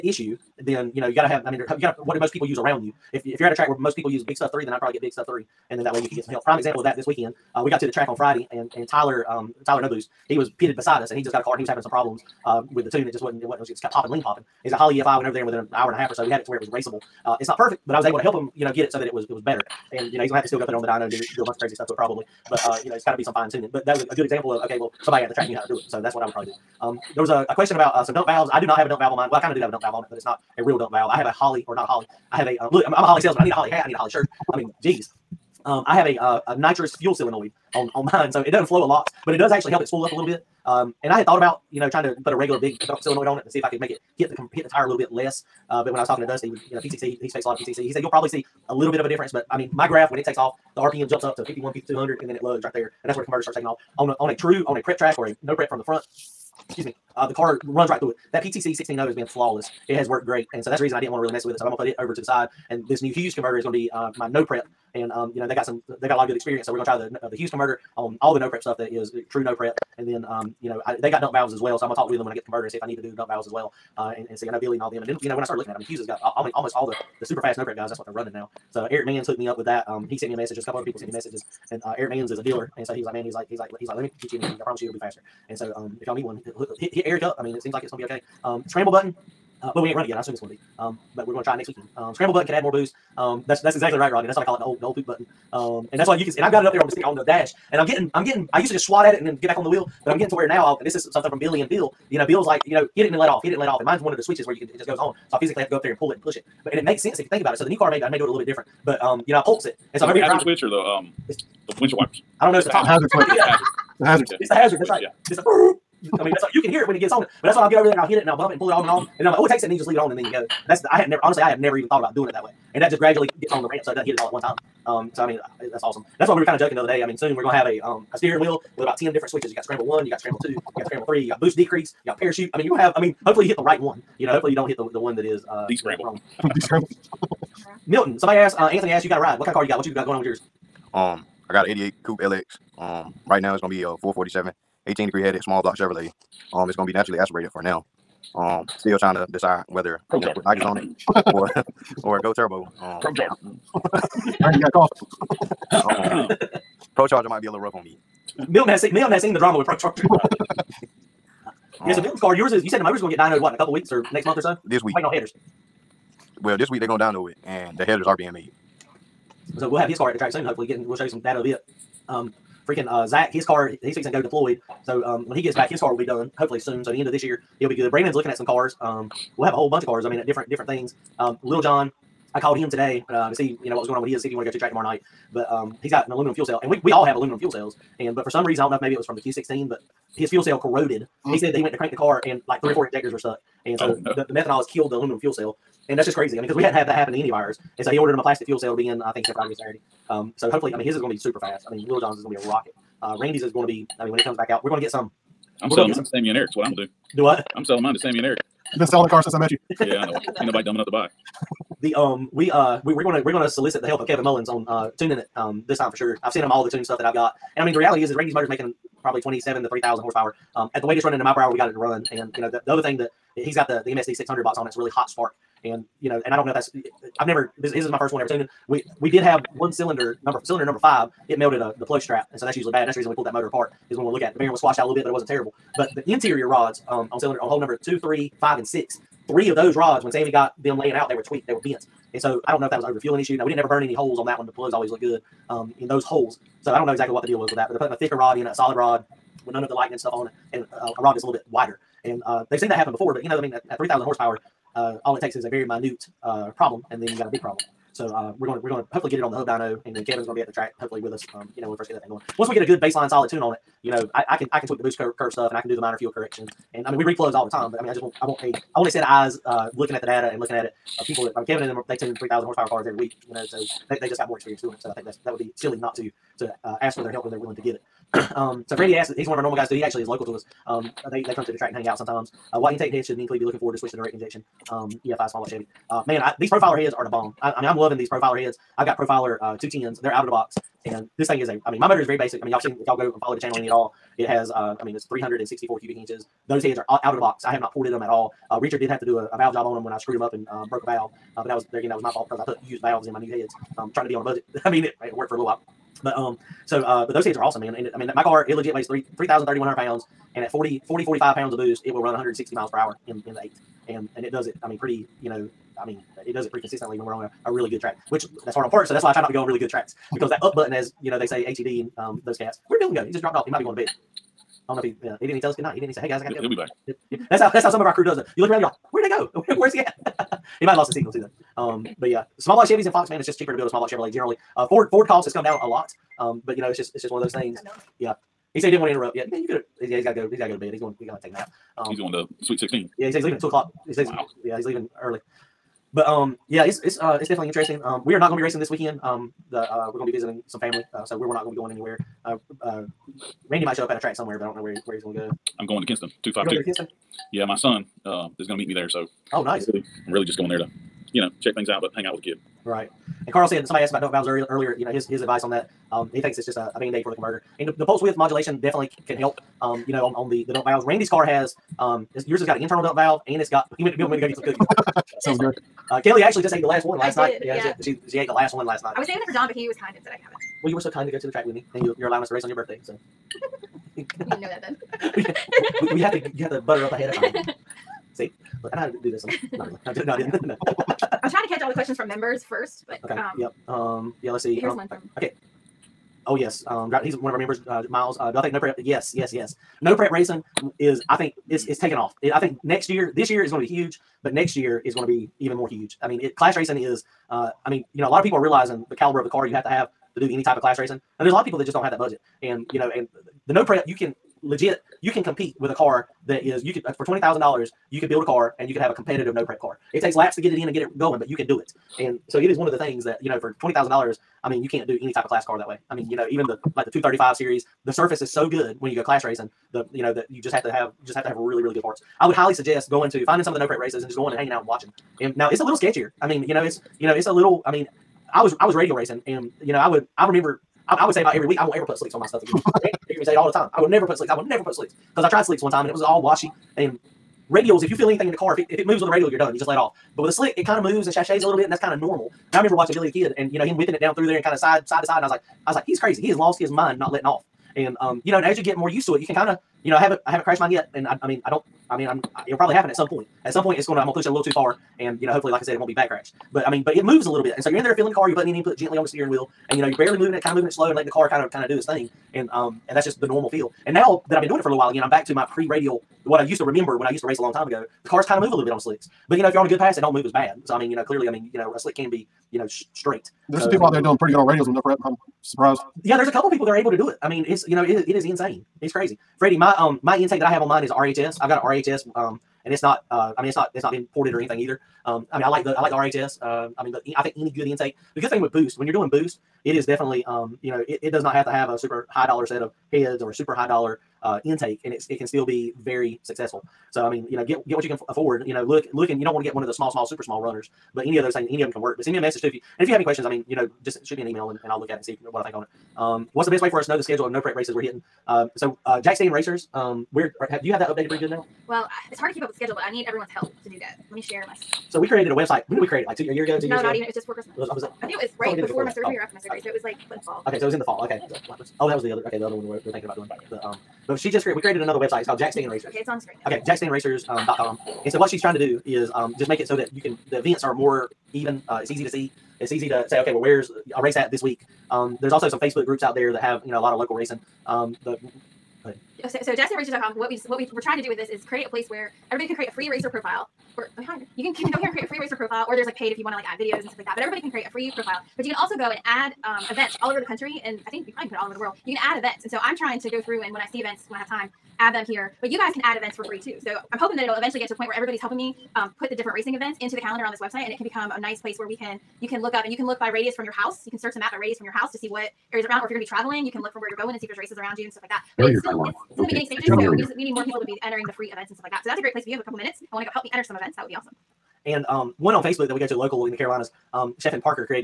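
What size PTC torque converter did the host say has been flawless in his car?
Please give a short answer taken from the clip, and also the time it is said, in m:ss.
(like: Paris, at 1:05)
16.0, at 0:58.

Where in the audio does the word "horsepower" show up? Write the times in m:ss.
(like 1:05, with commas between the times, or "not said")
3:40, 4:14, 4:32.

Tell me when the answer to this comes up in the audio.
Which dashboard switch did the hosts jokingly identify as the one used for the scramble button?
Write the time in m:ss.
1:52.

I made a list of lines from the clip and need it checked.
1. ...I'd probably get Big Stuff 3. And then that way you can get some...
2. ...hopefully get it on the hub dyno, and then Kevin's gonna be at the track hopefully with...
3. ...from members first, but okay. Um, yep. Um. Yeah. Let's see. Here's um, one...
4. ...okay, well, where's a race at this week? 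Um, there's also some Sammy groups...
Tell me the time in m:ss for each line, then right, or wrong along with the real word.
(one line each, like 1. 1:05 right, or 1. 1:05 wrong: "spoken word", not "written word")
1. 0:04 right
2. 4:18 right
3. 6:31 right
4. 9:03 wrong: "Facebook", not "Sammy".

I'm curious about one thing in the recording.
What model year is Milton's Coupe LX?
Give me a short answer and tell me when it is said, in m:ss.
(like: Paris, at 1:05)
1988, at 2:21.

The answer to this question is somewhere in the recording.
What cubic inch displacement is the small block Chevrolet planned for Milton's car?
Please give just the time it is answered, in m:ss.
2:24.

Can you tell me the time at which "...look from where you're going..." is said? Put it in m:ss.
9:36.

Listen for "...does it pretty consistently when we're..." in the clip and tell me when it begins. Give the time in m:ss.
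5:16.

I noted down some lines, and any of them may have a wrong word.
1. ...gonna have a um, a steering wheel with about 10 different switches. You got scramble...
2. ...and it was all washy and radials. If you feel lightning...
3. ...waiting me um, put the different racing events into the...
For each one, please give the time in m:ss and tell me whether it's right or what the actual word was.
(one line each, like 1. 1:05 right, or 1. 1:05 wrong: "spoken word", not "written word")
1. 2:07 right
2. 7:25 wrong: "anything", not "lightning"
3. 9:28 wrong: "helping", not "waiting".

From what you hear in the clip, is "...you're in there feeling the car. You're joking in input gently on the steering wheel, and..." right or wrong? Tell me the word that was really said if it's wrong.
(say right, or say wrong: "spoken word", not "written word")
wrong: "putting", not "joking".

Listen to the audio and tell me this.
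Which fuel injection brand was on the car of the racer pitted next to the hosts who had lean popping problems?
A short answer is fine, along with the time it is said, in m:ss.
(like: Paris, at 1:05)
Holley EFI, at 0:14.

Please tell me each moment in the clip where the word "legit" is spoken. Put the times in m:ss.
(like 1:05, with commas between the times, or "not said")
5:08, 6:54.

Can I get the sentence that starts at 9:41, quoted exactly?
So that's a great place if you have a couple minutes and want to go help me enter some events.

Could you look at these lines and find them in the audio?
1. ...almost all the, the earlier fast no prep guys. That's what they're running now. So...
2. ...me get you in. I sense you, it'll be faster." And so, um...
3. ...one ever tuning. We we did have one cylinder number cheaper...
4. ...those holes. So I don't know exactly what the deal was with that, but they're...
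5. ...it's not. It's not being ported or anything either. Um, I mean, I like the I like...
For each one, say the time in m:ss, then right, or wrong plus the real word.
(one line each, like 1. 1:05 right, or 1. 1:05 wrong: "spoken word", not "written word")
1. 1:16 wrong: "super", not "earlier"
2. 1:24 wrong: "promise", not "sense"
3. 3:48 wrong: "cylinder", not "cheaper"
4. 4:05 right
5. 8:13 right.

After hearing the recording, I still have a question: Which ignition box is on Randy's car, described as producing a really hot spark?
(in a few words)
MSD 600.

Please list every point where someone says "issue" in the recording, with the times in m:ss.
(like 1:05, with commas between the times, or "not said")
0:00, 4:03.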